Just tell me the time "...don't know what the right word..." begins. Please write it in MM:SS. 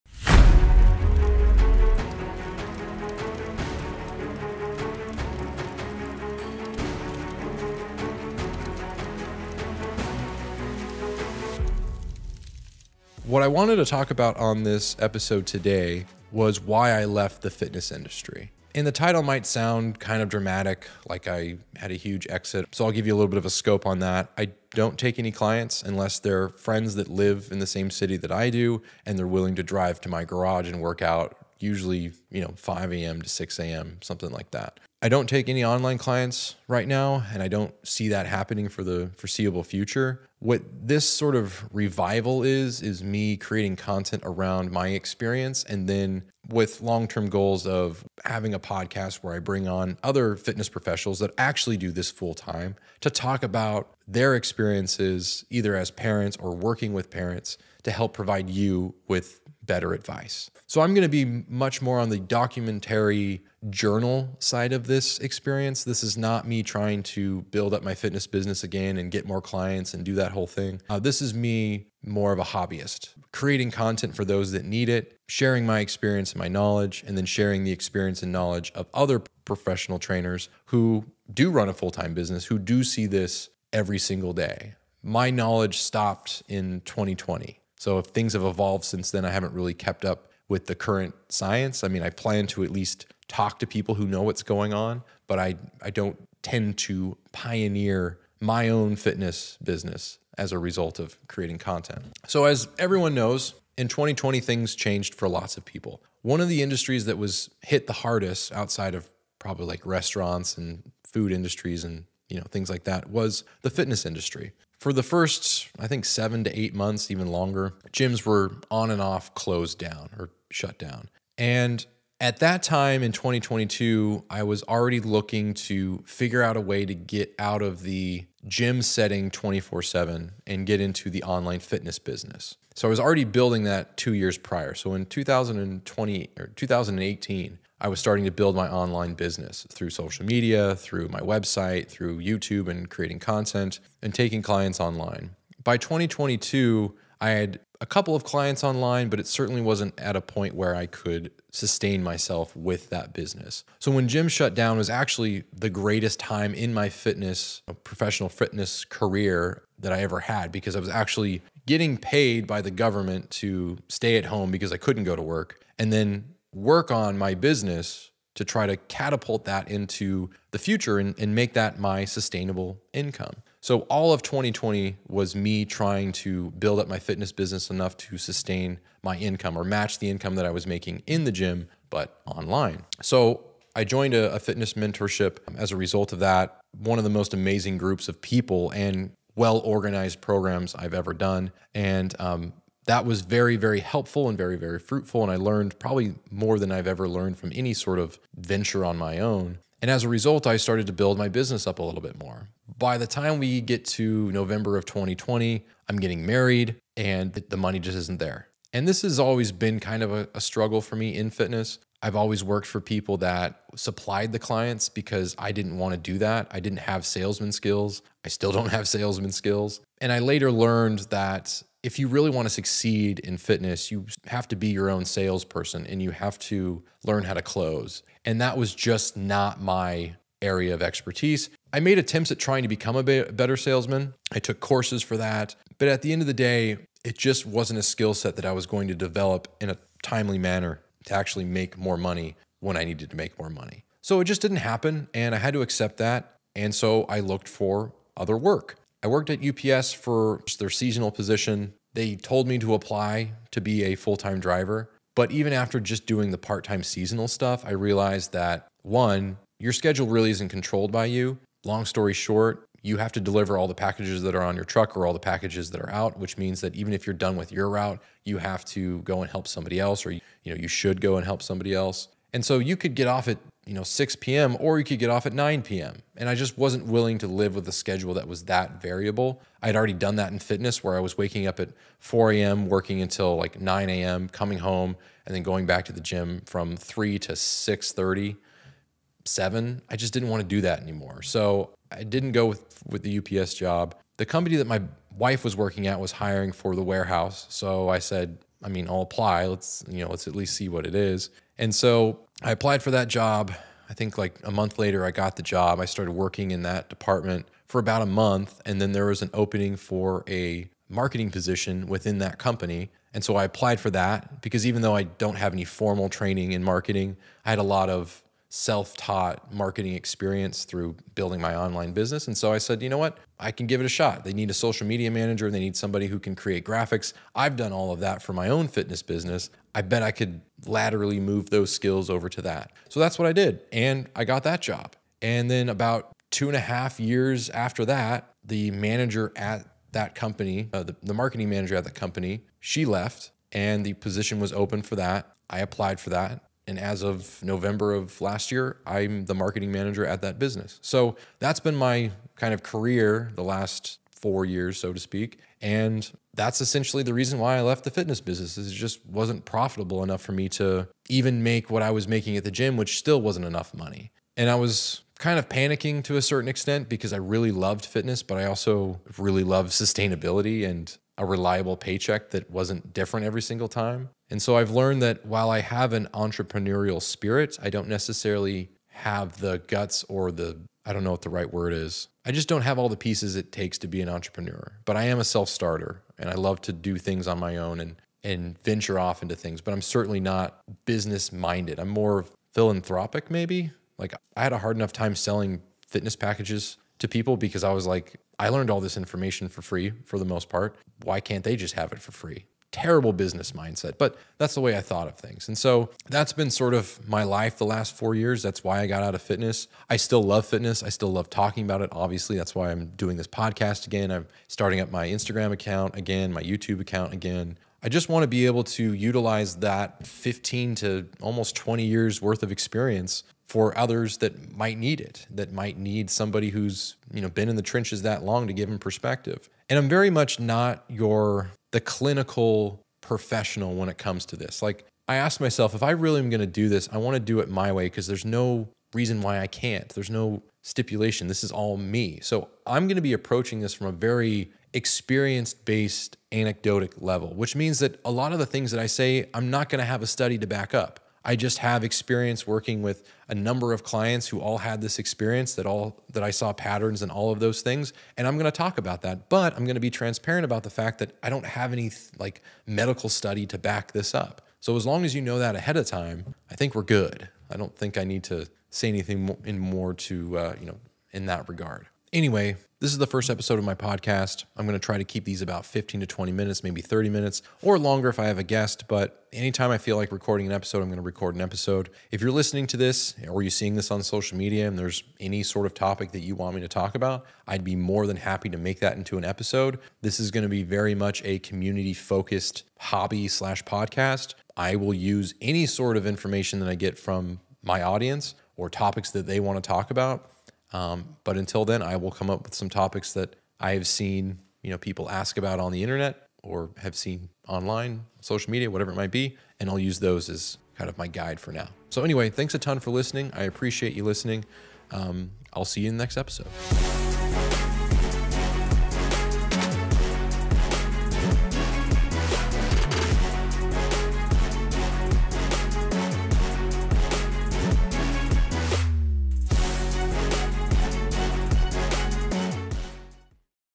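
06:20.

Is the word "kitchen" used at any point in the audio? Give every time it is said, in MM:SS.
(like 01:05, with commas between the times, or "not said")
not said.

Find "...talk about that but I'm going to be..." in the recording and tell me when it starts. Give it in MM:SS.
07:38.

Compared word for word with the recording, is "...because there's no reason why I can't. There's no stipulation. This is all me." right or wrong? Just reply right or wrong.
right.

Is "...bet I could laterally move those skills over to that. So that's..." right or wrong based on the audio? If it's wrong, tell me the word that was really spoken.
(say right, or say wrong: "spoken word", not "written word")
right.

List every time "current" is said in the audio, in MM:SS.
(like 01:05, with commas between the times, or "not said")
01:30.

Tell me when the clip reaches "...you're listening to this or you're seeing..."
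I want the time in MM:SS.
08:02.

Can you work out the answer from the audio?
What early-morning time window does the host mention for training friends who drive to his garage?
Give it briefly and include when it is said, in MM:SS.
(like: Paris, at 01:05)
5 a.m. to 6 a.m., at 00:32.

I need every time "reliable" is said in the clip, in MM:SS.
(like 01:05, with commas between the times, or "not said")
06:11.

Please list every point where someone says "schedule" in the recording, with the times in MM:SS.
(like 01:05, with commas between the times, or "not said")
04:19, 04:37.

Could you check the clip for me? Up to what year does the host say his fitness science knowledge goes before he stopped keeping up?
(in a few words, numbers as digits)
2020.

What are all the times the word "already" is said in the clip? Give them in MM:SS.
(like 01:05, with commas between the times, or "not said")
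02:04, 02:12, 04:39.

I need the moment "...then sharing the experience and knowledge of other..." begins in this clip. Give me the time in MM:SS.
01:17.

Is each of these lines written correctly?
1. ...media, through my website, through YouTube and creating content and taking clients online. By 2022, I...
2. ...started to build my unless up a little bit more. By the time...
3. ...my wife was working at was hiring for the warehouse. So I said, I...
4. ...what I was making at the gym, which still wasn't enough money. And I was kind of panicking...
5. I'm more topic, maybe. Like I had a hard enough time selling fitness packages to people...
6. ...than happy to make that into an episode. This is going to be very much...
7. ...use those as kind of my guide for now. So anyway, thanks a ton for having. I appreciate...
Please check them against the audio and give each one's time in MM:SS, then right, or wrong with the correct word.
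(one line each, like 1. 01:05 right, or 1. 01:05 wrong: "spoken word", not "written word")
1. 02:20 right
2. 03:20 wrong: "business", not "unless"
3. 04:54 right
4. 06:01 right
5. 06:31 wrong: "philanthropic", not "topic"
6. 08:08 right
7. 08:29 wrong: "listening", not "having".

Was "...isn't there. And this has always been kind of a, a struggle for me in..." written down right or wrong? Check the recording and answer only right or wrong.
right.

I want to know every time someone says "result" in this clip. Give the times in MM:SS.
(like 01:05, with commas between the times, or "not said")
01:40, 03:05, 03:20.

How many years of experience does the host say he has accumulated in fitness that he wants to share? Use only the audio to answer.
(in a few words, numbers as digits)
15 to 20 years.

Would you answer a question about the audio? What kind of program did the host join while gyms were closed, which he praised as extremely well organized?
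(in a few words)
fitness mentorship.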